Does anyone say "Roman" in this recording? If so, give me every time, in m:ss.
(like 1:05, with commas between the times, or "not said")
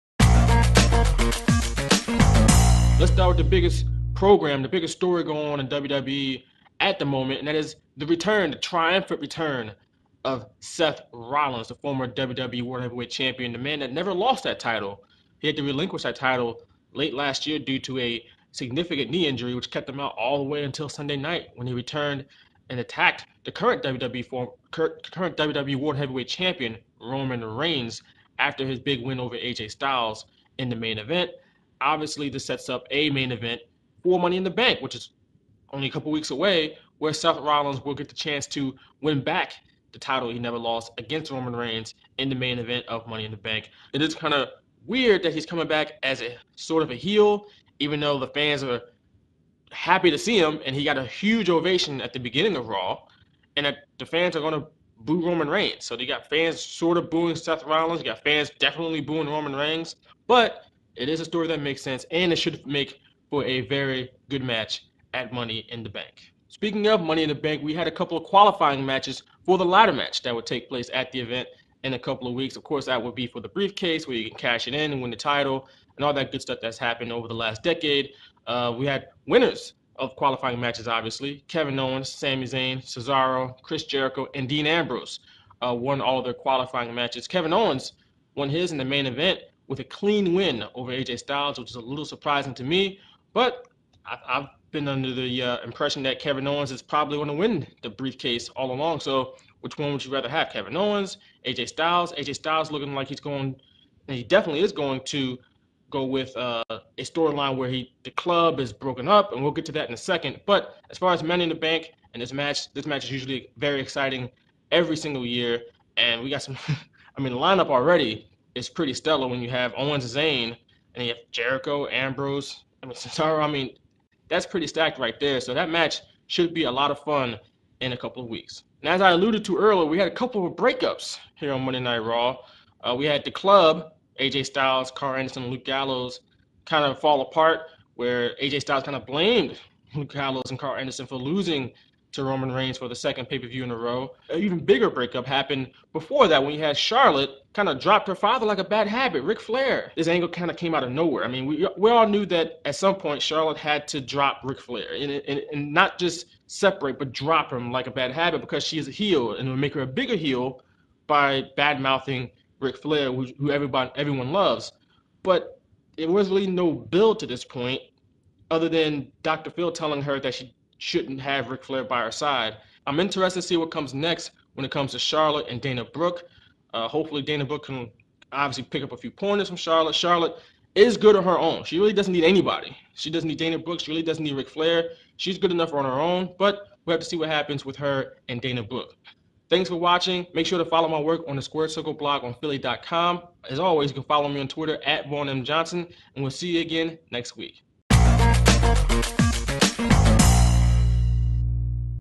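0:26, 0:41, 0:55, 0:59, 2:22.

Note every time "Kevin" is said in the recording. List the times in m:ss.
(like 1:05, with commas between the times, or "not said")
1:21, 1:27, 1:36, 1:40.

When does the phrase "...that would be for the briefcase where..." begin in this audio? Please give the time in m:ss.
1:12.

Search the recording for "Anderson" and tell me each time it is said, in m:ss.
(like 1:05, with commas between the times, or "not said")
2:15, 2:20.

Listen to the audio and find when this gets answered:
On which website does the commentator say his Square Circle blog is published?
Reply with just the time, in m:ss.
3:12.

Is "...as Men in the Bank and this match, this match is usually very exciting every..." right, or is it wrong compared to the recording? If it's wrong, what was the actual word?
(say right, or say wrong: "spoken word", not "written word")
right.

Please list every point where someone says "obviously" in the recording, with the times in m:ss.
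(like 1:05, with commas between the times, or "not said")
0:31, 1:20, 2:58.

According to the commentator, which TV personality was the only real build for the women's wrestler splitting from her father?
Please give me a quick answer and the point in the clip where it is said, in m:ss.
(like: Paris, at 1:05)
Dr. Phil, at 2:49.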